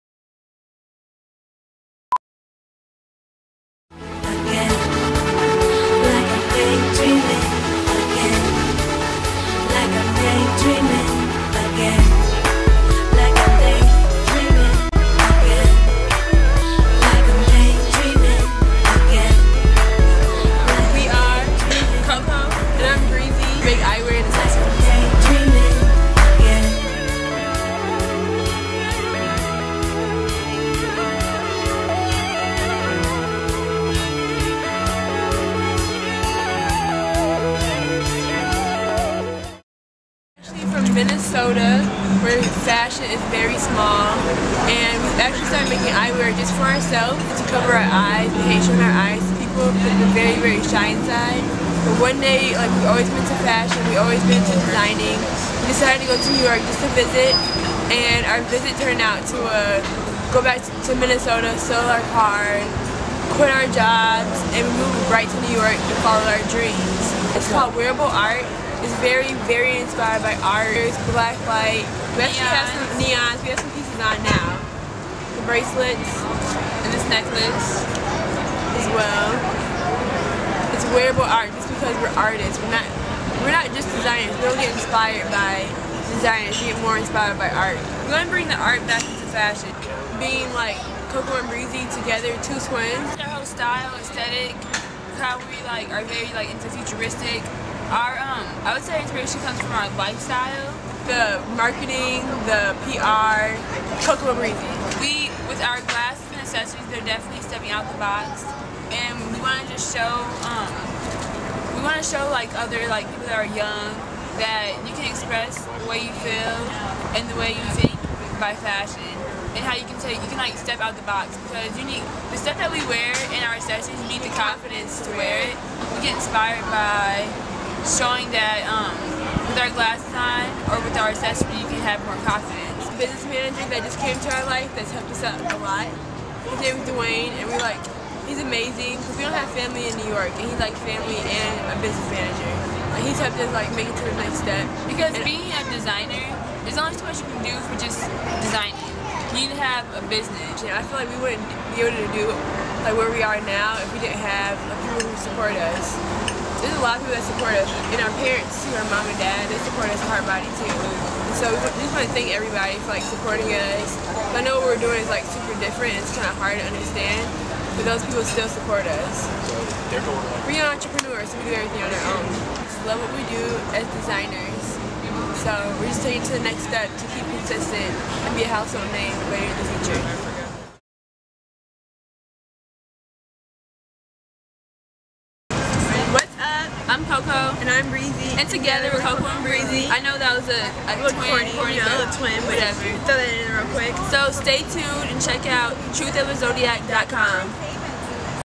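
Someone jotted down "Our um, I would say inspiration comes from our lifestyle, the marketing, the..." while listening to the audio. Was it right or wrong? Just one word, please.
right.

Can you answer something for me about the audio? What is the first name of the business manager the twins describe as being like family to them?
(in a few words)
Dwayne.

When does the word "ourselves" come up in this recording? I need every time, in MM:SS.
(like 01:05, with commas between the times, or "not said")
00:46.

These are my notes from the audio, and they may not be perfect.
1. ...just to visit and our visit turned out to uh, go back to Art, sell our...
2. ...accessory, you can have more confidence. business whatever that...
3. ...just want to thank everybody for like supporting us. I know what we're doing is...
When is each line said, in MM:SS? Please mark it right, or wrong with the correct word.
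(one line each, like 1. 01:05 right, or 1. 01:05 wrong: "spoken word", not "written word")
1. 00:56 wrong: "Minnesota", not "Art"
2. 02:11 wrong: "manager", not "whatever"
3. 02:41 right.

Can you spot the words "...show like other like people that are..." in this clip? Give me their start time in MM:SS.
01:52.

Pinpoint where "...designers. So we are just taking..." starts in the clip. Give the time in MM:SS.
02:53.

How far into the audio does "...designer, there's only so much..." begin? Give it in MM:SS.
02:25.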